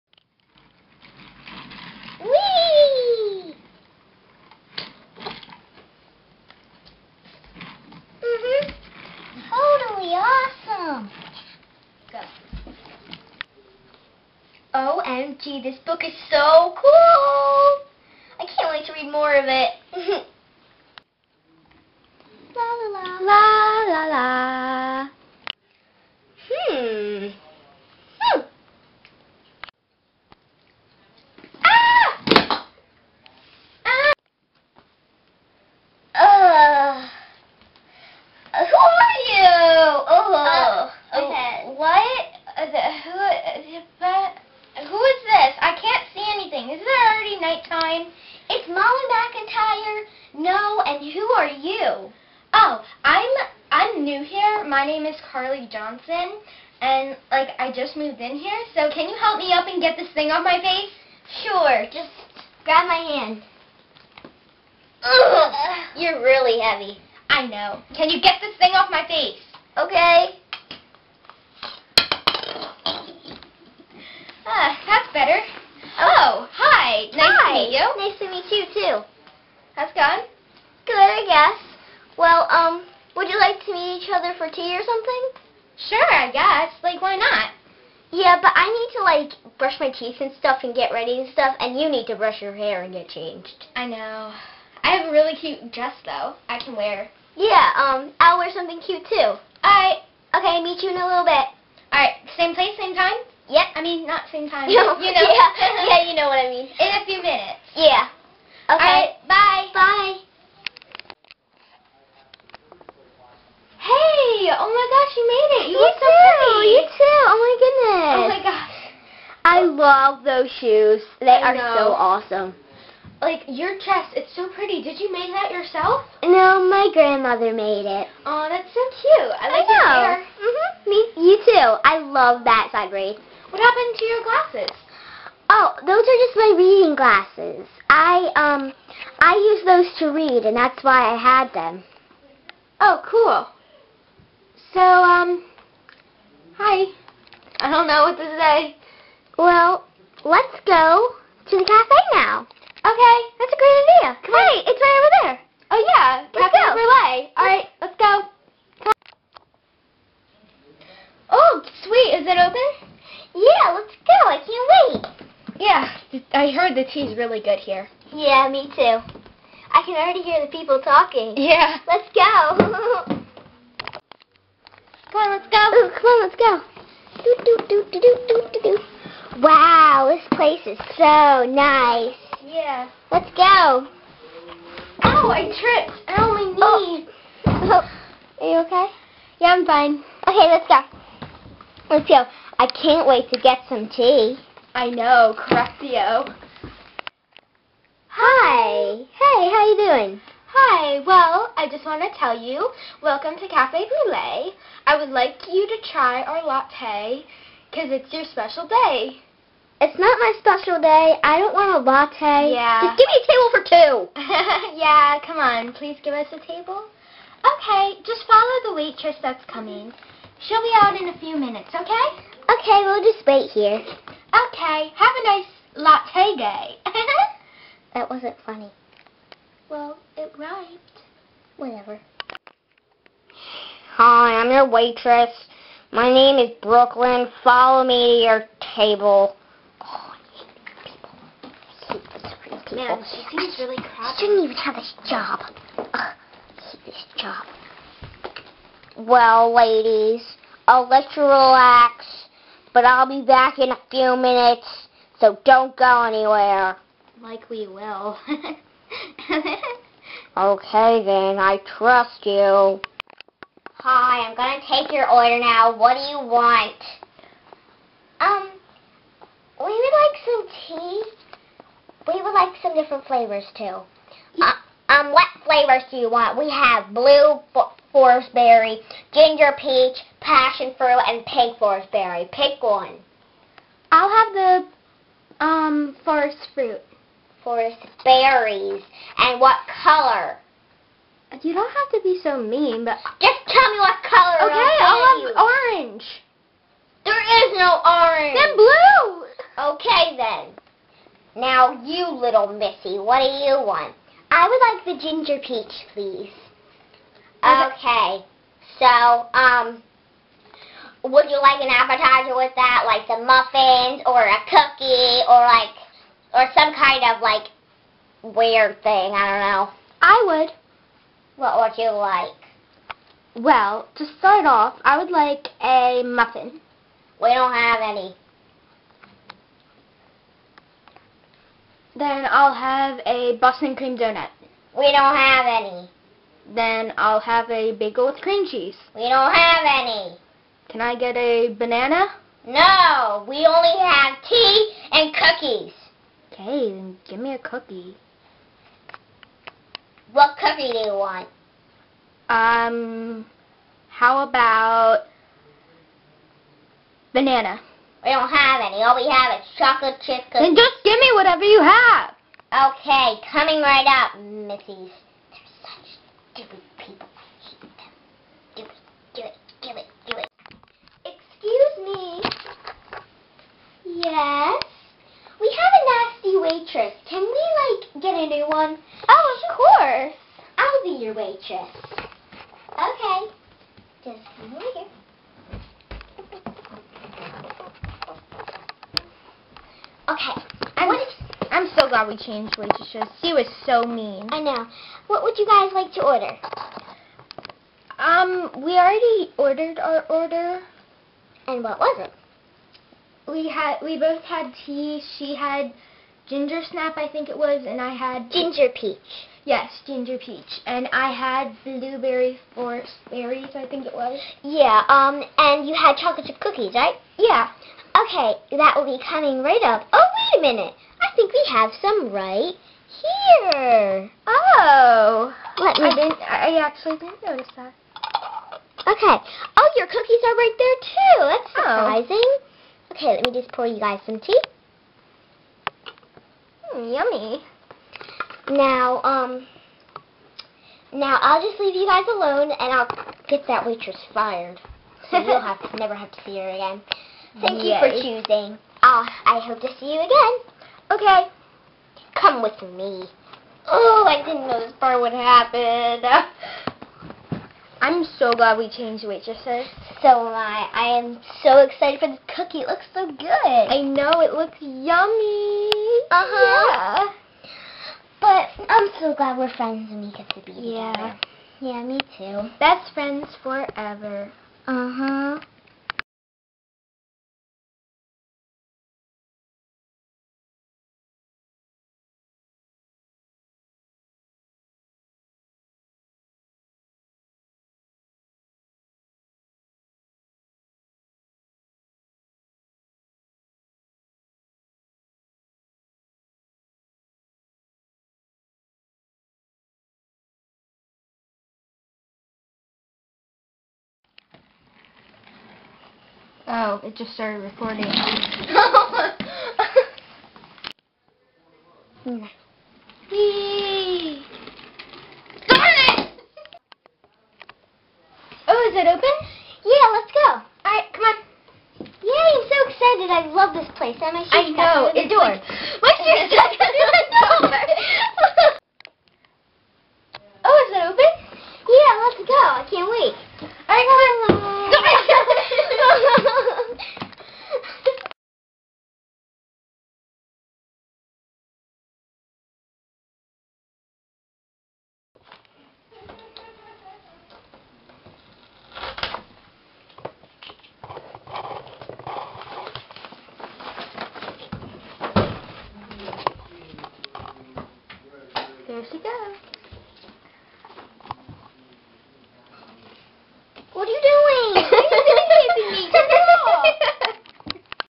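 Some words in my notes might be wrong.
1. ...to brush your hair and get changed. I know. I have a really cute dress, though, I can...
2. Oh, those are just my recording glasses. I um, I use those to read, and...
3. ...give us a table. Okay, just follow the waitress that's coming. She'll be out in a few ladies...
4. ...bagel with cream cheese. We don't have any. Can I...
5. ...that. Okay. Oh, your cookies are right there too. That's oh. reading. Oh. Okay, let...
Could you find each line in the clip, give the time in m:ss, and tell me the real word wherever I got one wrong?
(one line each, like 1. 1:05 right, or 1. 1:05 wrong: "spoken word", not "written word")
1. 1:32 right
2. 2:15 wrong: "reading", not "recording"
3. 3:36 wrong: "minutes", not "ladies"
4. 5:37 right
5. 7:07 wrong: "surprising", not "reading".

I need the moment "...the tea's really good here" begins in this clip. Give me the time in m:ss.
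2:46.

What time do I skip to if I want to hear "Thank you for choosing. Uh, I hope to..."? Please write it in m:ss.
7:27.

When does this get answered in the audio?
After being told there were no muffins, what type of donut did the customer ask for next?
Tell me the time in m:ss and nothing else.
5:33.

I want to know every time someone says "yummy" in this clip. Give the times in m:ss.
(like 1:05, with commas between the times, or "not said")
7:16, 7:44.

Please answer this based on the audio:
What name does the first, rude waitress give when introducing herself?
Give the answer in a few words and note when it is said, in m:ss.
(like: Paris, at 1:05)
Brooklyn, at 3:56.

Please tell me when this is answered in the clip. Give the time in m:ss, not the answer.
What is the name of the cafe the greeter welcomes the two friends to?
3:23.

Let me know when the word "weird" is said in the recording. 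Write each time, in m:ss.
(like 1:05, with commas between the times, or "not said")
5:18.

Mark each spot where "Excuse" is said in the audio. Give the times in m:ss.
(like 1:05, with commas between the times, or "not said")
6:11.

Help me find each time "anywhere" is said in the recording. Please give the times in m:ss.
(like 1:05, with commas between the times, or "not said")
4:16.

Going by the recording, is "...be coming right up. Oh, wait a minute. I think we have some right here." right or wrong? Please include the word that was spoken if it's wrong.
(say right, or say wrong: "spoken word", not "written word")
right.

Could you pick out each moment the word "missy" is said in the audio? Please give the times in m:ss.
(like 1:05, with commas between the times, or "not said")
5:02, 6:04.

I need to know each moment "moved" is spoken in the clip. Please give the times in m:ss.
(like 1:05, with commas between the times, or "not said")
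0:57.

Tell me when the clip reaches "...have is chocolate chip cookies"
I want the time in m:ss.
5:59.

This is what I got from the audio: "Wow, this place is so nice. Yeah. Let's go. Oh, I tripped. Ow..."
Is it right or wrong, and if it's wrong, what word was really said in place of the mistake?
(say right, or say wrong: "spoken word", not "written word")
right.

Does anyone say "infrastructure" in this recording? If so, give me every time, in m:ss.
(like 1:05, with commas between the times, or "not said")
not said.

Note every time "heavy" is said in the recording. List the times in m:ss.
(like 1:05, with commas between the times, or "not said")
1:06.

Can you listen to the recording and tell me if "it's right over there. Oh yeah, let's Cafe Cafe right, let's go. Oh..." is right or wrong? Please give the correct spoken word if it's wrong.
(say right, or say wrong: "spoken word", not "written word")
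wrong: "All", not "Cafe".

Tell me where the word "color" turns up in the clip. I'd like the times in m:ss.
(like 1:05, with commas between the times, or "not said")
4:49, 4:54.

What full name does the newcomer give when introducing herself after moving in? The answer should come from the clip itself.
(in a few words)
Carly Johnson.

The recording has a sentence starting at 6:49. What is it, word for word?
Yes, ginger peach, and I had blueberry forest berries, I think it was.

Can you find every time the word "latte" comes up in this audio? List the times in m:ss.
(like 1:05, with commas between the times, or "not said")
3:26, 3:31, 3:45.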